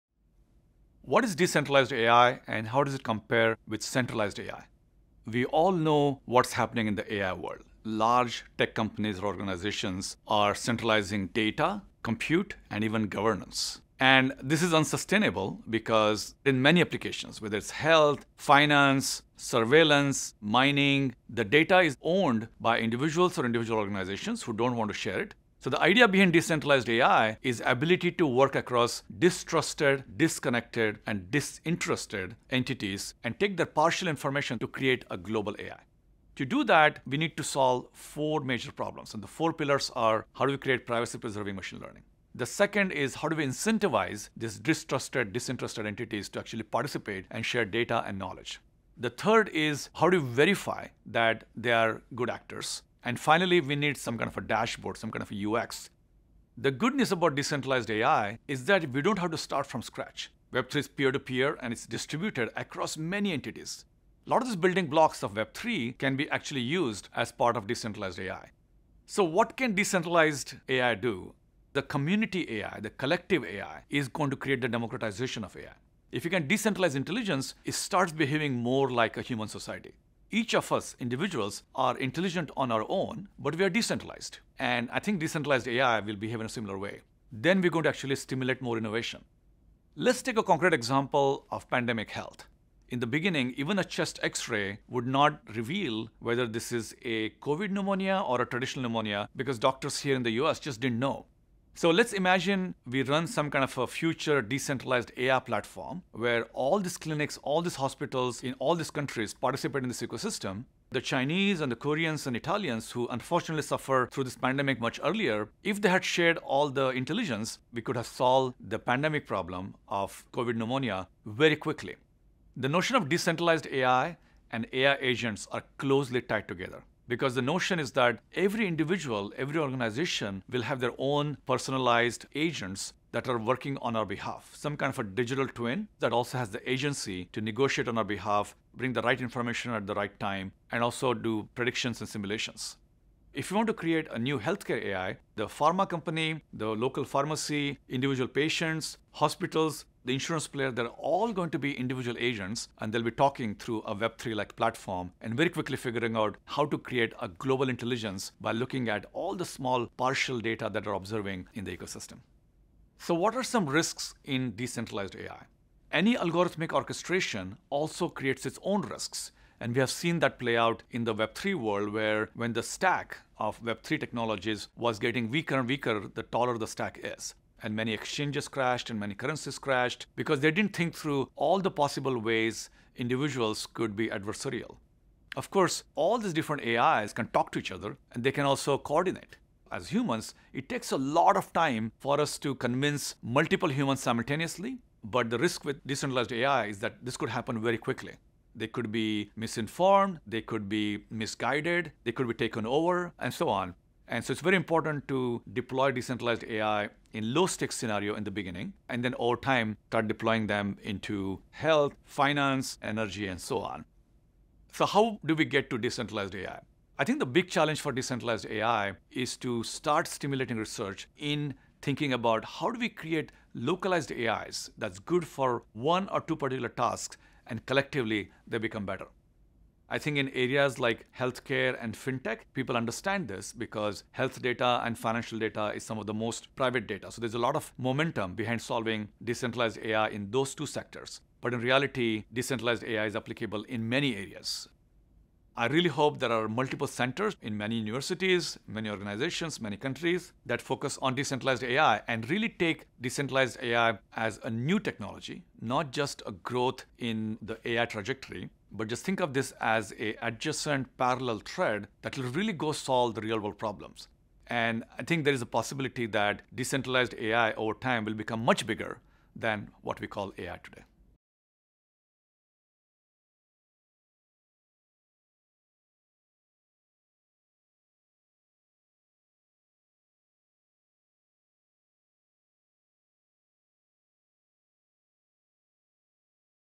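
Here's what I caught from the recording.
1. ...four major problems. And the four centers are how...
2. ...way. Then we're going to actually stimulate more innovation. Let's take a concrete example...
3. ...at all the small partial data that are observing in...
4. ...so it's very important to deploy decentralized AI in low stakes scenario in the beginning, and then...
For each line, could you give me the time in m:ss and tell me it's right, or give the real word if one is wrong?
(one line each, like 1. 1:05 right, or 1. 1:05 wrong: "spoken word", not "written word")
1. 0:37 wrong: "pillars", not "centers"
2. 1:26 right
3. 2:38 right
4. 3:24 right.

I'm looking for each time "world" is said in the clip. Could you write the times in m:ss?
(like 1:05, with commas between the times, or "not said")
0:07, 2:51, 4:23.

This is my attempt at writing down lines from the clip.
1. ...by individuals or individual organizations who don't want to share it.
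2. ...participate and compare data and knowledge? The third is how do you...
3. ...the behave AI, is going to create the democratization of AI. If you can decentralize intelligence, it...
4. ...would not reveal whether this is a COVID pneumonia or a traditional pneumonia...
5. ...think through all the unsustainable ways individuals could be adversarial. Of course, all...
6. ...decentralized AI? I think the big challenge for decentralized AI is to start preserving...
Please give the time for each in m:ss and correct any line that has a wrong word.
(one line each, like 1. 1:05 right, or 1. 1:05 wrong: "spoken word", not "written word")
1. 0:22 right
2. 0:46 wrong: "share", not "compare"
3. 1:12 wrong: "collective", not "behave"
4. 1:34 right
5. 3:00 wrong: "possible", not "unsustainable"
6. 3:35 wrong: "stimulating", not "preserving".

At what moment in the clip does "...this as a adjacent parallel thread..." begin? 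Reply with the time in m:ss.
4:19.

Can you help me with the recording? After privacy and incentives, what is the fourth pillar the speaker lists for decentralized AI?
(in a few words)
UX.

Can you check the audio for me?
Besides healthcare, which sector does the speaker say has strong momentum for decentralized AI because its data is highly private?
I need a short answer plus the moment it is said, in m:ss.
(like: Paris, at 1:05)
fintech, at 3:51.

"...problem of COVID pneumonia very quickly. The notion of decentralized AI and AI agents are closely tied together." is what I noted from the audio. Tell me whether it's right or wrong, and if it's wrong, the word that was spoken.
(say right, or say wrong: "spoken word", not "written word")
right.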